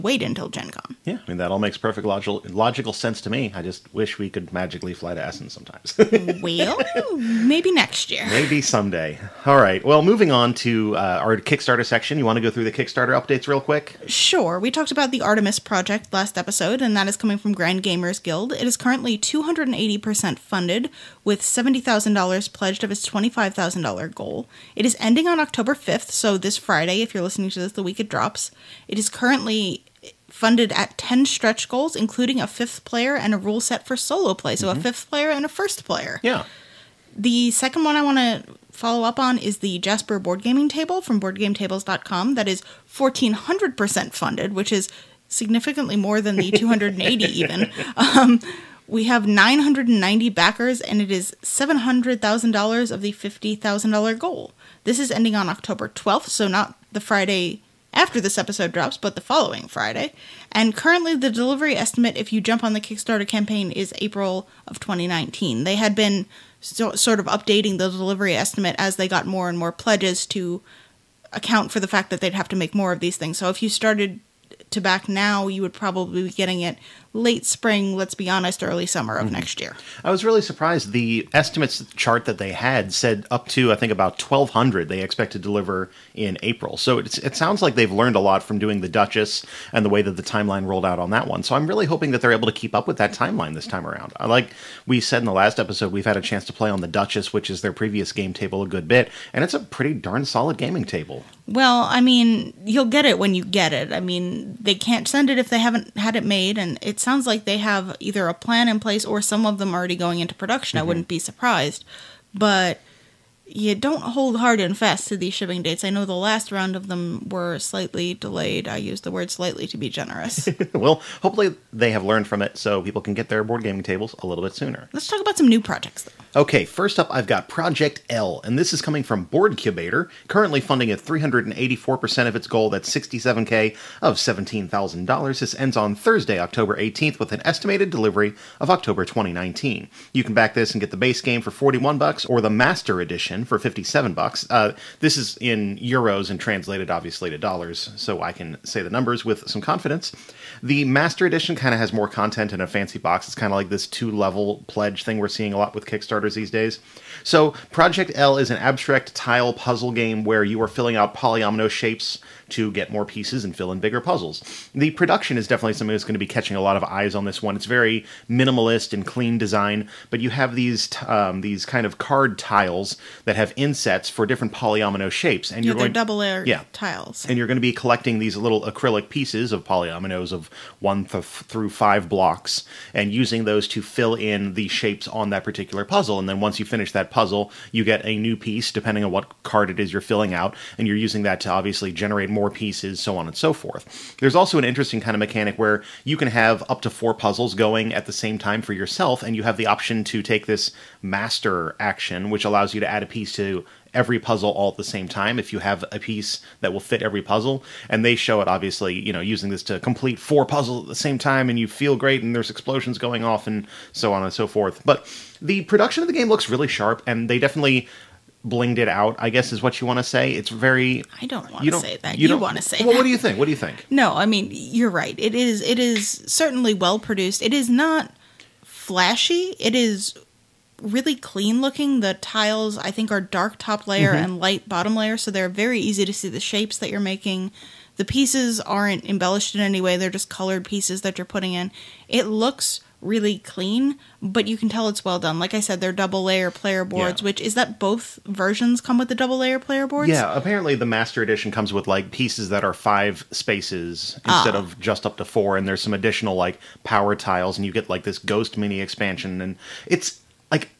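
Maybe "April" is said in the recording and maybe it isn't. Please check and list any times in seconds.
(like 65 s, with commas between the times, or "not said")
63 s, 86 s.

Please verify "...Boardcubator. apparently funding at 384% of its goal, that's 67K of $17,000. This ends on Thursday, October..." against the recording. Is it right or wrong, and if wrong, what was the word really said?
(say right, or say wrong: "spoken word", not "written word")
wrong: "currently", not "apparently".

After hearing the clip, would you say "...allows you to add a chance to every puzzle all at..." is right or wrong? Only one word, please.
wrong.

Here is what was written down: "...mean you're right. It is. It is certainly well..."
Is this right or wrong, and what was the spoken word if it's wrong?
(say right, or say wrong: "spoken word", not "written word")
right.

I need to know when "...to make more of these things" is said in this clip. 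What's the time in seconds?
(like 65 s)
72 s.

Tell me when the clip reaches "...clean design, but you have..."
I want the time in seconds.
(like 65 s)
169 s.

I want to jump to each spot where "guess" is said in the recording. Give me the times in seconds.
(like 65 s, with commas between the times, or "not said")
219 s.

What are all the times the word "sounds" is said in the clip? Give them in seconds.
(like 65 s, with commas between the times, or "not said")
87 s, 107 s.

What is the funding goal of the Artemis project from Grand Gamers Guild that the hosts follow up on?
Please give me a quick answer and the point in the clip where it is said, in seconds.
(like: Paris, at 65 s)
$25,000, at 23 s.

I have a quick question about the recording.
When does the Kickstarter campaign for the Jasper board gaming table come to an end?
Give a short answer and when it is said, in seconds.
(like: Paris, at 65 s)
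October 12th, at 55 s.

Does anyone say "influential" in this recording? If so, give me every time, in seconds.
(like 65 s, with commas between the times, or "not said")
not said.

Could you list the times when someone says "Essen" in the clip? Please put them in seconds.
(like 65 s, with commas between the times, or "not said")
5 s.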